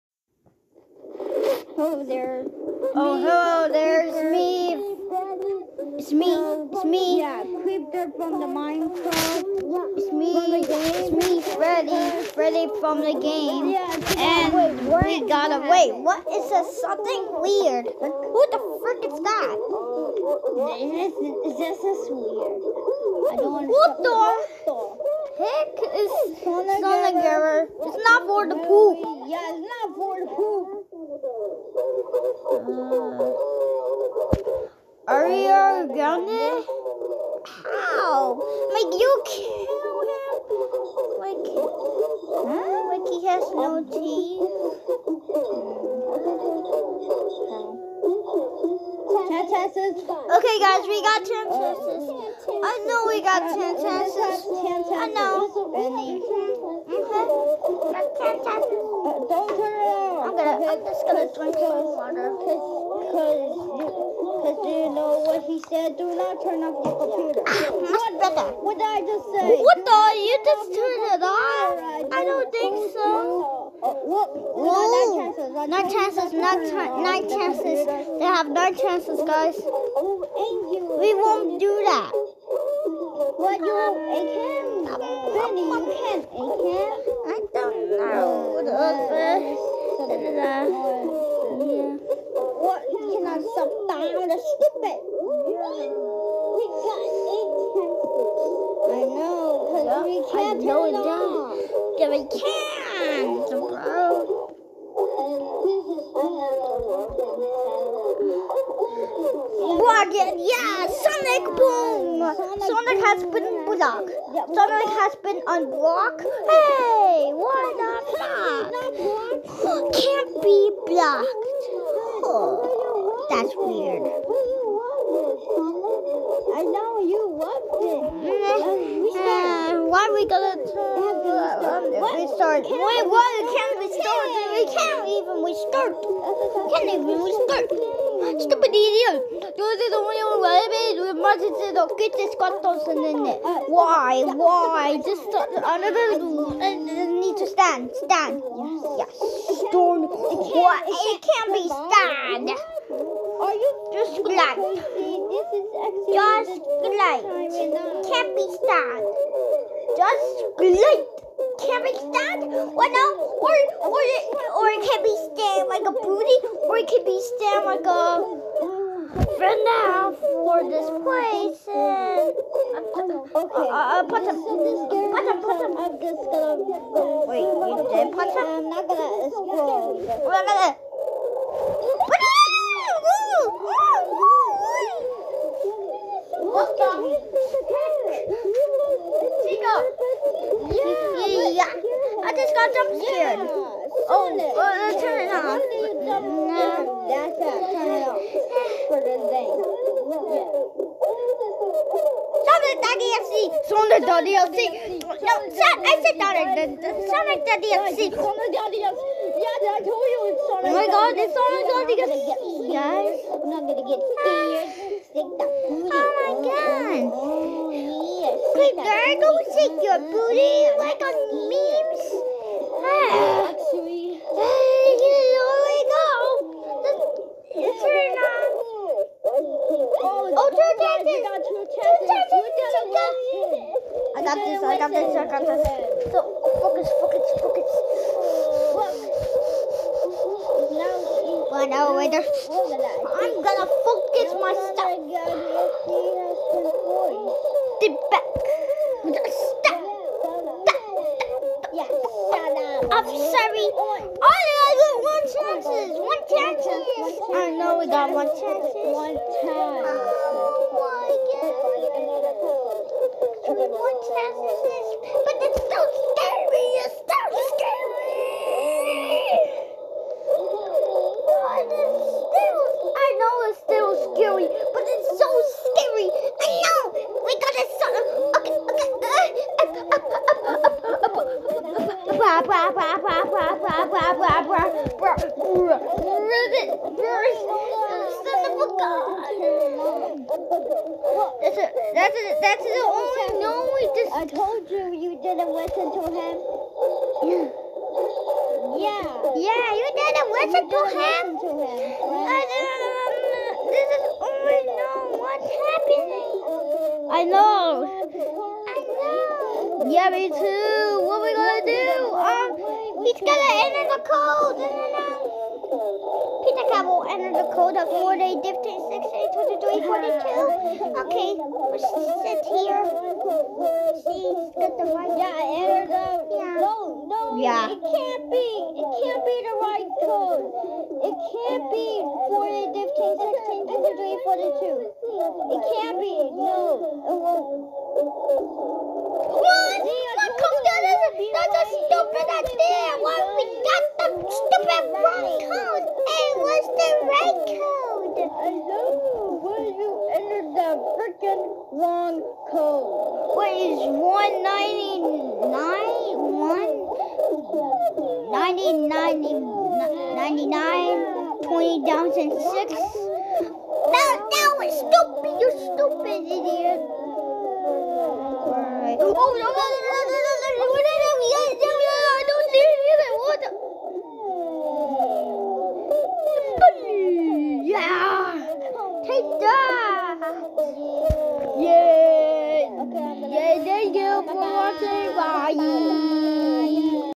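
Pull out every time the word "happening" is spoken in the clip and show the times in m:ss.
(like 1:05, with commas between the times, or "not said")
5:05.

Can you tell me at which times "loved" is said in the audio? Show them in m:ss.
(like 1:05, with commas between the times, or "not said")
2:07.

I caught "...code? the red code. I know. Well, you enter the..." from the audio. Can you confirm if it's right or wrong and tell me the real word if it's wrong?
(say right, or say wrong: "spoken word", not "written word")
right.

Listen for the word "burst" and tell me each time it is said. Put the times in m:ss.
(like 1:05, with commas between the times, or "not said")
4:46.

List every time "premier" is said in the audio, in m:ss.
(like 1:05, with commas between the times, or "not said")
not said.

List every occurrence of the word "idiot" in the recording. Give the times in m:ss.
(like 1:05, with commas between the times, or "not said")
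2:18, 6:06.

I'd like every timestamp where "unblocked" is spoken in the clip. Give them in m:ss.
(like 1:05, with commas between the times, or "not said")
1:55.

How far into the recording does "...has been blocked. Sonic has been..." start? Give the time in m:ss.
1:53.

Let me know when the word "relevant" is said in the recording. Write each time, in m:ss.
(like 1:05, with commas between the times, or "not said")
2:20.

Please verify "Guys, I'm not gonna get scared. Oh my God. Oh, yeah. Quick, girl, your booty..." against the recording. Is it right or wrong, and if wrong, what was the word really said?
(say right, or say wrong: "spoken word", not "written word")
right.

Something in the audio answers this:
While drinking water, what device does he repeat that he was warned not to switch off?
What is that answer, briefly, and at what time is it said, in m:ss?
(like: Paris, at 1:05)
your computer, at 1:06.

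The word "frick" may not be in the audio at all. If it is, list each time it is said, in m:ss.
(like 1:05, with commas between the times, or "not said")
0:18.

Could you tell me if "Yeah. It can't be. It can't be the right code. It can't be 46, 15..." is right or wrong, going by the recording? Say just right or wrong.
wrong.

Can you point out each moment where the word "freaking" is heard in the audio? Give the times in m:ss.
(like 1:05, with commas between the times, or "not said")
5:50.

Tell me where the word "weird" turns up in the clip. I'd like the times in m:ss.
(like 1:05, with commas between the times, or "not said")
0:17, 0:22, 2:03.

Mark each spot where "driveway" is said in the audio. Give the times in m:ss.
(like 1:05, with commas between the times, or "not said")
not said.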